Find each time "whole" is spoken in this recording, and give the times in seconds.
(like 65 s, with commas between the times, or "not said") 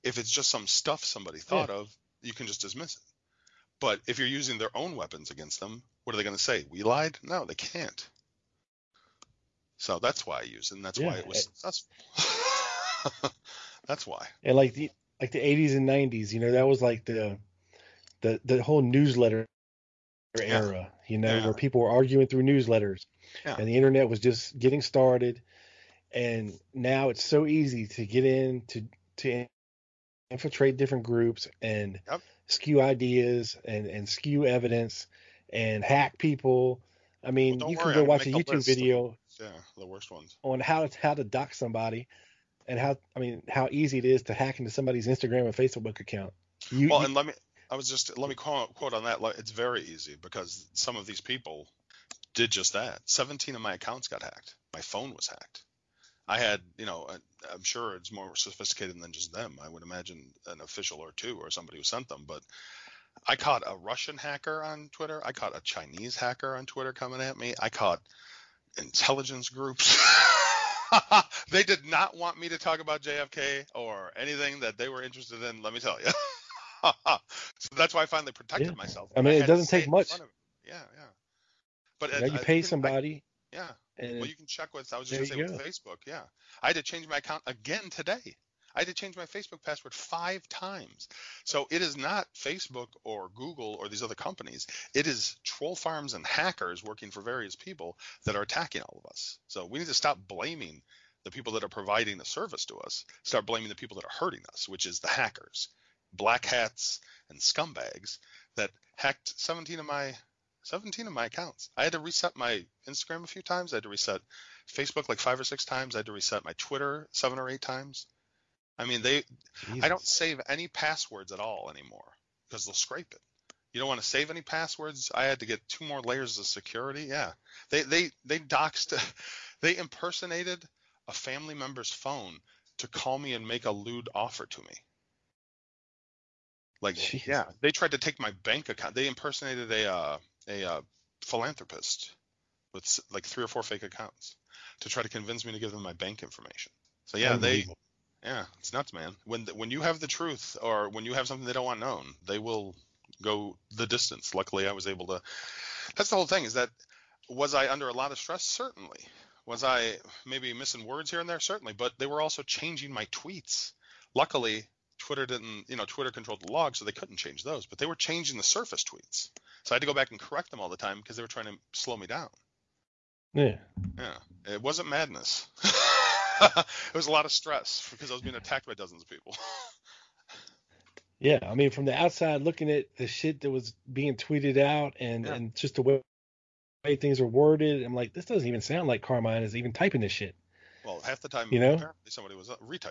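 18 s, 156 s.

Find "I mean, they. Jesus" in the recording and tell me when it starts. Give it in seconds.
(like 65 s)
118 s.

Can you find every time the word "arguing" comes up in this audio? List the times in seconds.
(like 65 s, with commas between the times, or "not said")
21 s.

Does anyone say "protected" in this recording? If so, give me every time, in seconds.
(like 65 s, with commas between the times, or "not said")
78 s.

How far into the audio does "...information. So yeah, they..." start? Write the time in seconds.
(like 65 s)
146 s.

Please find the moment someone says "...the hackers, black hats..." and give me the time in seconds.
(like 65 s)
104 s.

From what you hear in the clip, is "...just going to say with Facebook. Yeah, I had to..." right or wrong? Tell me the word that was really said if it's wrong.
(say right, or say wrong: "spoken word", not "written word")
right.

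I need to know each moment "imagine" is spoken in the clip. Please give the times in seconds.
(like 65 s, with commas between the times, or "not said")
59 s.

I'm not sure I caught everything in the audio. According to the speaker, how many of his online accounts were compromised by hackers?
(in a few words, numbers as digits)
17.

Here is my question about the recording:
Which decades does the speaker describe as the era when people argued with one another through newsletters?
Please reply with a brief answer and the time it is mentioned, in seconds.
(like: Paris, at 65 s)
80s and 90s, at 15 s.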